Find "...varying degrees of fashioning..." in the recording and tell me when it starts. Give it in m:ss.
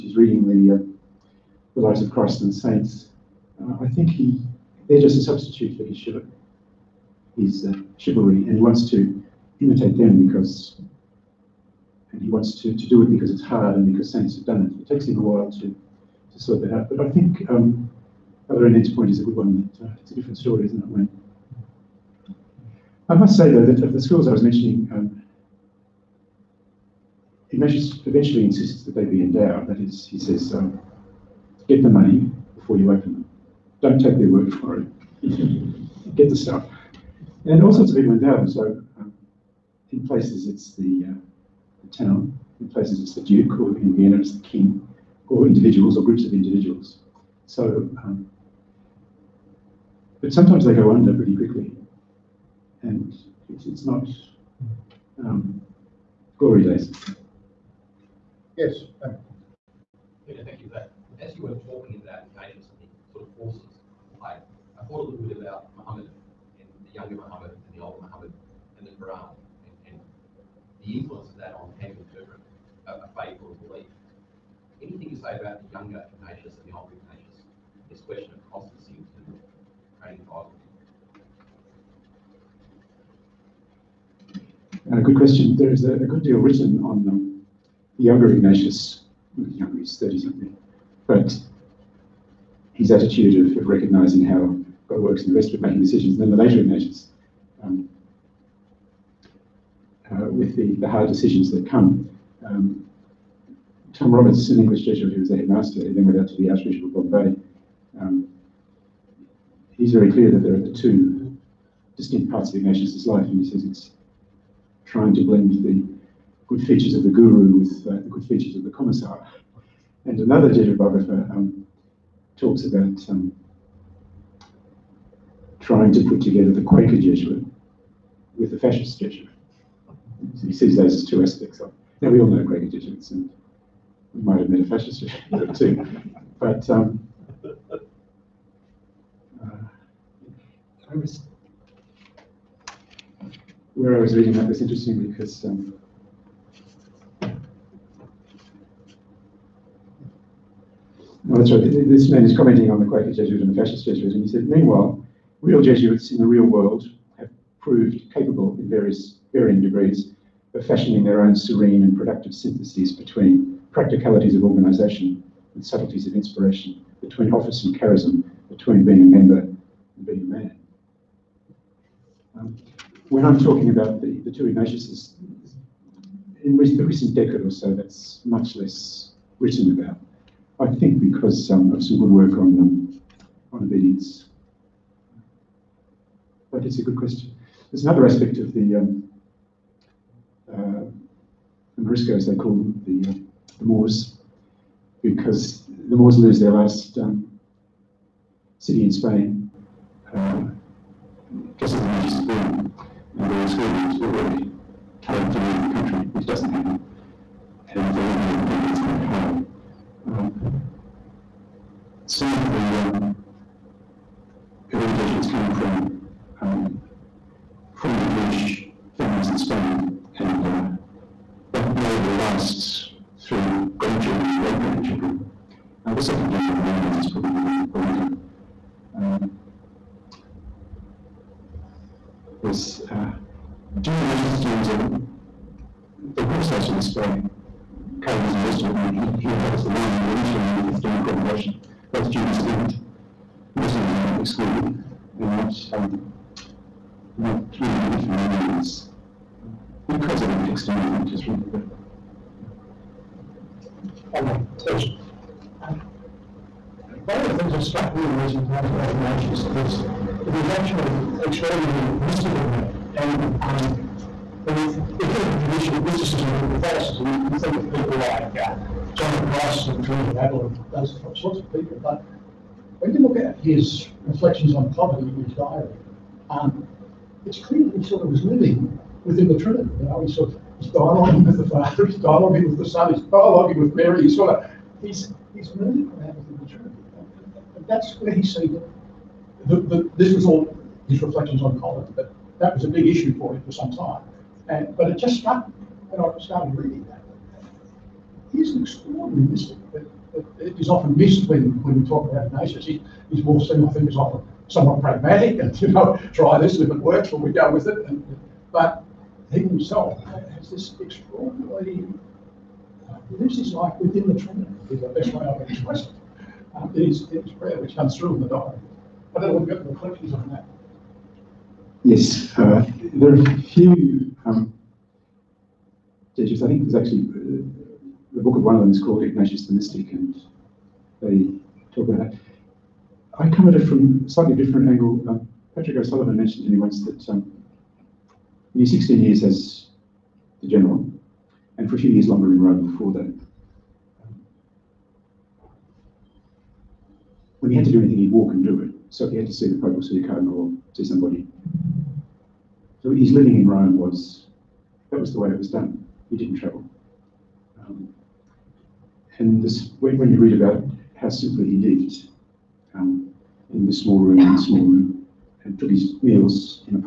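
2:39.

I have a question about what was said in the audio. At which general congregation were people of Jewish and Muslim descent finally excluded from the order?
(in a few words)
the fifth.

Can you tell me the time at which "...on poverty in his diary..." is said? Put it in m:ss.
4:34.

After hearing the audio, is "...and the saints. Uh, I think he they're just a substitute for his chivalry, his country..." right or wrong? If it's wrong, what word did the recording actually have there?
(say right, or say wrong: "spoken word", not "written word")
wrong: "chivalry", not "country".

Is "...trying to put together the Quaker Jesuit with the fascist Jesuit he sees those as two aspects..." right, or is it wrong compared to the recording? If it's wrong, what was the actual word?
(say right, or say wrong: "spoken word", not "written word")
right.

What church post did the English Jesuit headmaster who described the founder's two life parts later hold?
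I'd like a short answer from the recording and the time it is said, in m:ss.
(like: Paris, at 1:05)
Archbishop of Bombay, at 1:46.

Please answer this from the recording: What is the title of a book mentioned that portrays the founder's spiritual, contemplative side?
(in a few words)
Ignatius the Mystic.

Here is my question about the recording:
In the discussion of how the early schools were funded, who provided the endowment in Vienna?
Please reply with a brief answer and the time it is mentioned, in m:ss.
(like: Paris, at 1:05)
the king, at 0:44.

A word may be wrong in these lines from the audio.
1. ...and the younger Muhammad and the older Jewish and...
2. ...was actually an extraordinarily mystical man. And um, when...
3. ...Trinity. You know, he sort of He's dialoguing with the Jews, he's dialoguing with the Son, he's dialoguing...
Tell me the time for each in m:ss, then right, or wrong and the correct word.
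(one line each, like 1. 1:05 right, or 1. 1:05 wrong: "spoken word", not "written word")
1. 1:06 wrong: "Muhammad", not "Jewish"
2. 4:20 right
3. 4:39 wrong: "Father", not "Jews".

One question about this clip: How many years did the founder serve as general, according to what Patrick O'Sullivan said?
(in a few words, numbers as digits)
16.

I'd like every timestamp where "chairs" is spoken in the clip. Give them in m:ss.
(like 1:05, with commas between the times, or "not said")
not said.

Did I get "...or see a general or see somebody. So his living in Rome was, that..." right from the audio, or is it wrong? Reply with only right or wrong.
wrong.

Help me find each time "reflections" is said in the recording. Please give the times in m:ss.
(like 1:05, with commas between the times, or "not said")
4:34, 4:51, 5:19.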